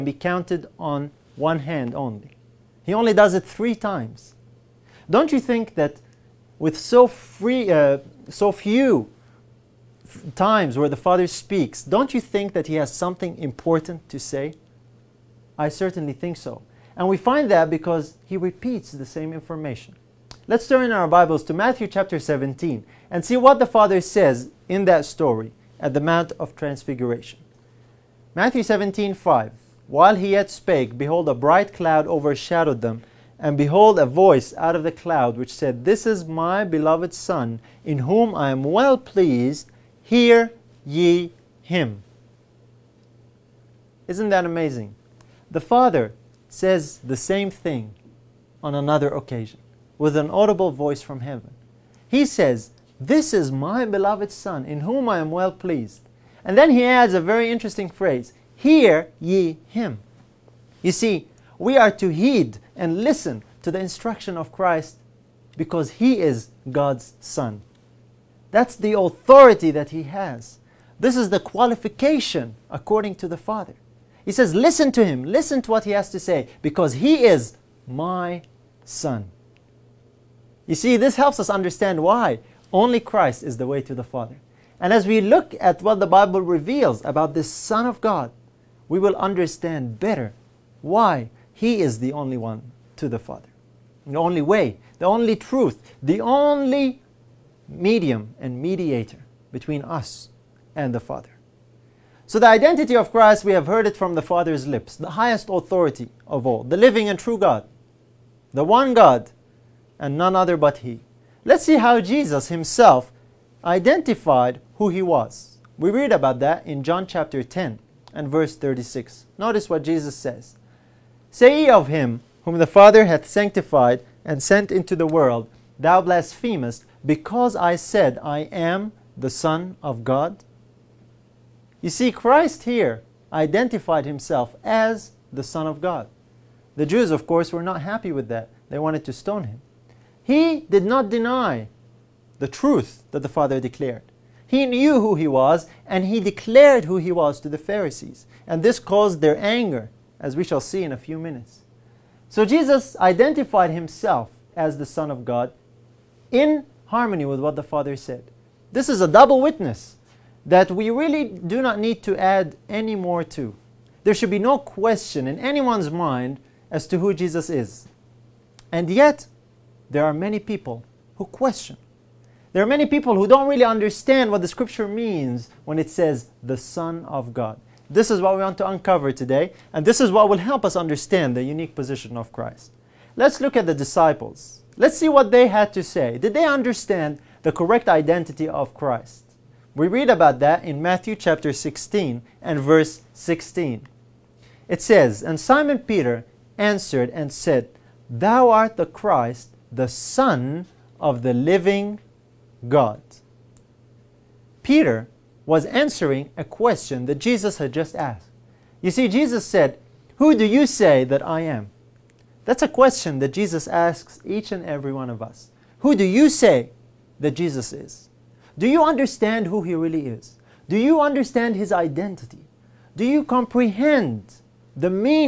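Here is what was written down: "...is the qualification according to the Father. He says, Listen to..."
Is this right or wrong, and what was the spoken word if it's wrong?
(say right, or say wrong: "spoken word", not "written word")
right.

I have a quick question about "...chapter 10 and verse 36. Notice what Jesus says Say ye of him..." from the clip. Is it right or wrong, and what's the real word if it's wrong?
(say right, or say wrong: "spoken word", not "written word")
right.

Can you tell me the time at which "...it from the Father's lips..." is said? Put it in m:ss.
1:43.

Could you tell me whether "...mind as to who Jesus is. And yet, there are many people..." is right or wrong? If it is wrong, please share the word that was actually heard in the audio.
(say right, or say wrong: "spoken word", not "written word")
right.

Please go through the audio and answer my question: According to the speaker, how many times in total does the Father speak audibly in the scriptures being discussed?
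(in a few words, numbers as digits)
3.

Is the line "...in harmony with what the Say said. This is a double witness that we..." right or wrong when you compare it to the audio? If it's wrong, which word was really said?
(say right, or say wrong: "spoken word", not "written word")
wrong: "Father", not "Say".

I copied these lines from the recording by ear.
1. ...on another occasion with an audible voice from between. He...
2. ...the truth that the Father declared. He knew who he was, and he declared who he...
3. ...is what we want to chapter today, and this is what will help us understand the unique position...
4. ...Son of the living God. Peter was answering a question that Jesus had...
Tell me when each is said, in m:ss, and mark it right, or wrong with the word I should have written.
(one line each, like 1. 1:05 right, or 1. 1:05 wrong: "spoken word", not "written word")
1. 0:48 wrong: "heaven", not "between"
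2. 2:22 right
3. 2:58 wrong: "uncover", not "chapter"
4. 3:19 right.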